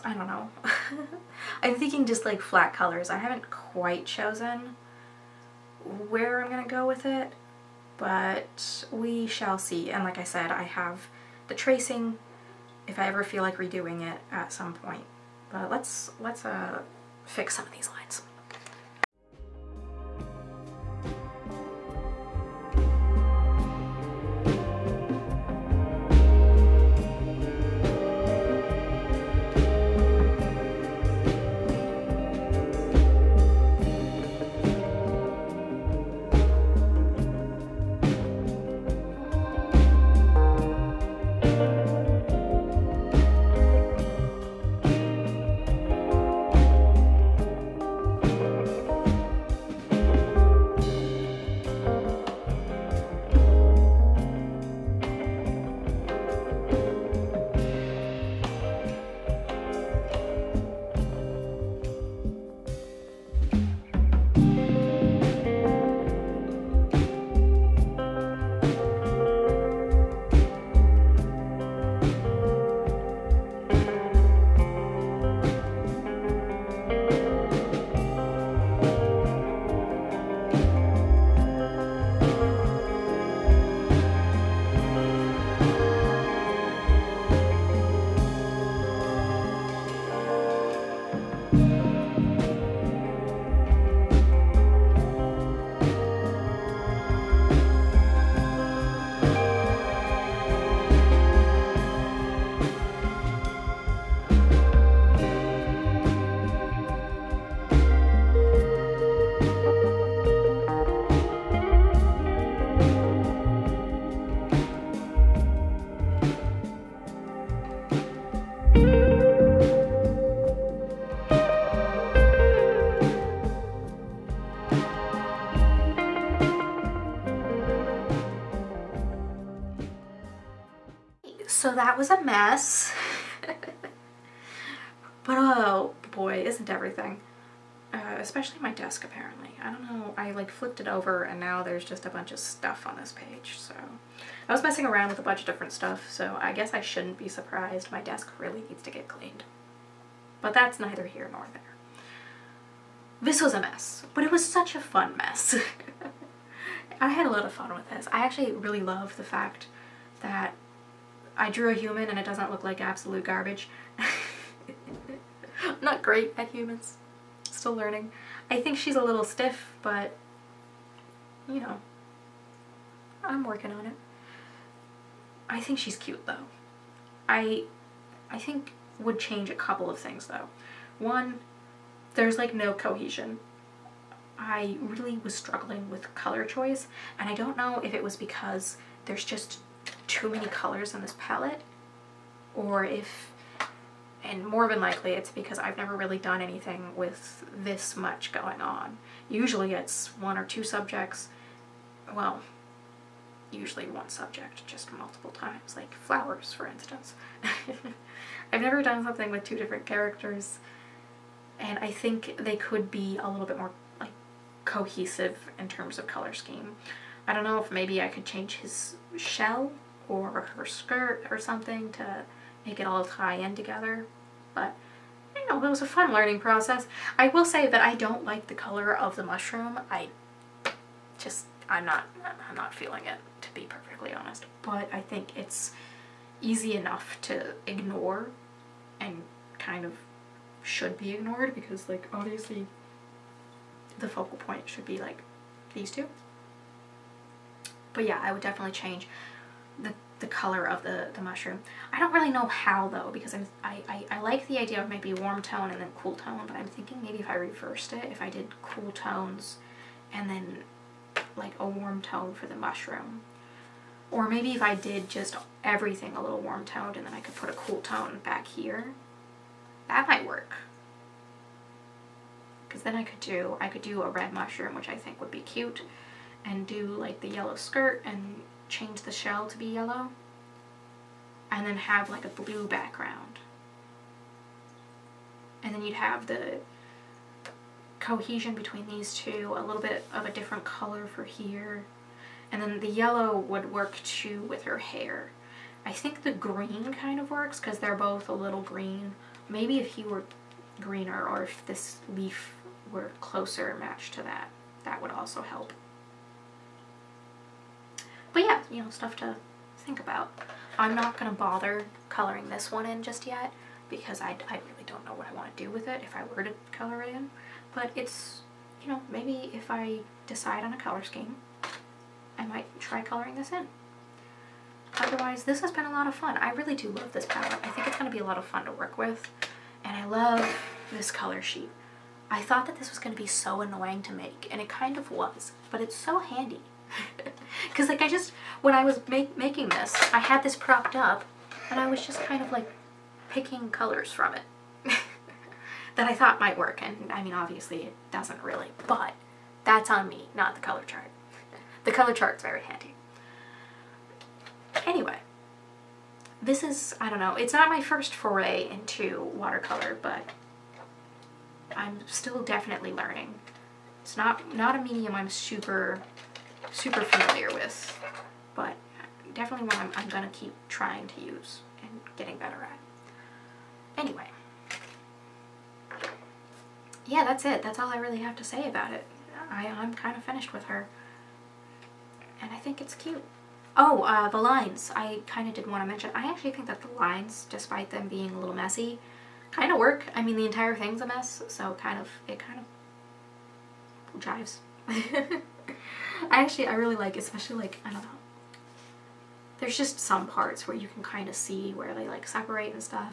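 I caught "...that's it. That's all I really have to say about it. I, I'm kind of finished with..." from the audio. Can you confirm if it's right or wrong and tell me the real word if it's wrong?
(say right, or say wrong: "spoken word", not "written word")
right.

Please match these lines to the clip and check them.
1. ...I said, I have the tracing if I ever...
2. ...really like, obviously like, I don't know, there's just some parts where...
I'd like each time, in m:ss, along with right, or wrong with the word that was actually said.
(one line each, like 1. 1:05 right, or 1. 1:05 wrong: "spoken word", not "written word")
1. 0:10 right
2. 6:36 wrong: "especially", not "obviously".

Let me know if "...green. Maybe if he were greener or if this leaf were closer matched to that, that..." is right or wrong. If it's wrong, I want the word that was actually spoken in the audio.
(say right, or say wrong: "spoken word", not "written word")
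right.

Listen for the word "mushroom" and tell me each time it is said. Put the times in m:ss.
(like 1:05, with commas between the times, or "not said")
3:49, 4:11, 4:22, 4:34.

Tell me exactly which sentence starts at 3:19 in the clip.
Usually it's one or two subjects, well, usually one subject, just multiple times, like flowers, for instance.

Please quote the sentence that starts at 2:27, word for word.
My desk really needs to get cleaned.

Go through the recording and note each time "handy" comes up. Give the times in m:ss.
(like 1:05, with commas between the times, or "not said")
5:36, 5:52.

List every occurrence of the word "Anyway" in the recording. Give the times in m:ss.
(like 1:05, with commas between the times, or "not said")
5:54, 6:13.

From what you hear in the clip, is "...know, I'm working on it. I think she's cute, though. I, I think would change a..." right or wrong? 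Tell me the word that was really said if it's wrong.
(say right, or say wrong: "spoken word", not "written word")
right.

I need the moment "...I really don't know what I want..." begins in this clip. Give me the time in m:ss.
5:14.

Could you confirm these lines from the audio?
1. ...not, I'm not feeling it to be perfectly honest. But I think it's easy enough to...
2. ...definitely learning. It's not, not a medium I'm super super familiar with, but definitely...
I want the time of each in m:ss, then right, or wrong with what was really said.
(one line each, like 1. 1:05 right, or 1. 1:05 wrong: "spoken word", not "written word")
1. 3:51 right
2. 6:02 right.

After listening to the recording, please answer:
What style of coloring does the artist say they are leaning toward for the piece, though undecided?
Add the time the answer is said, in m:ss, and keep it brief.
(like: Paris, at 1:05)
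flat colors, at 0:02.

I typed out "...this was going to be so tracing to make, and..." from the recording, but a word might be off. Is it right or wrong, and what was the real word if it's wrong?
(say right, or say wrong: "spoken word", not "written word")
wrong: "annoying", not "tracing".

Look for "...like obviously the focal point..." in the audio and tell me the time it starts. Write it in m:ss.
4:01.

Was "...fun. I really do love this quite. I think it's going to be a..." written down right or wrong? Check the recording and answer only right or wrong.
wrong.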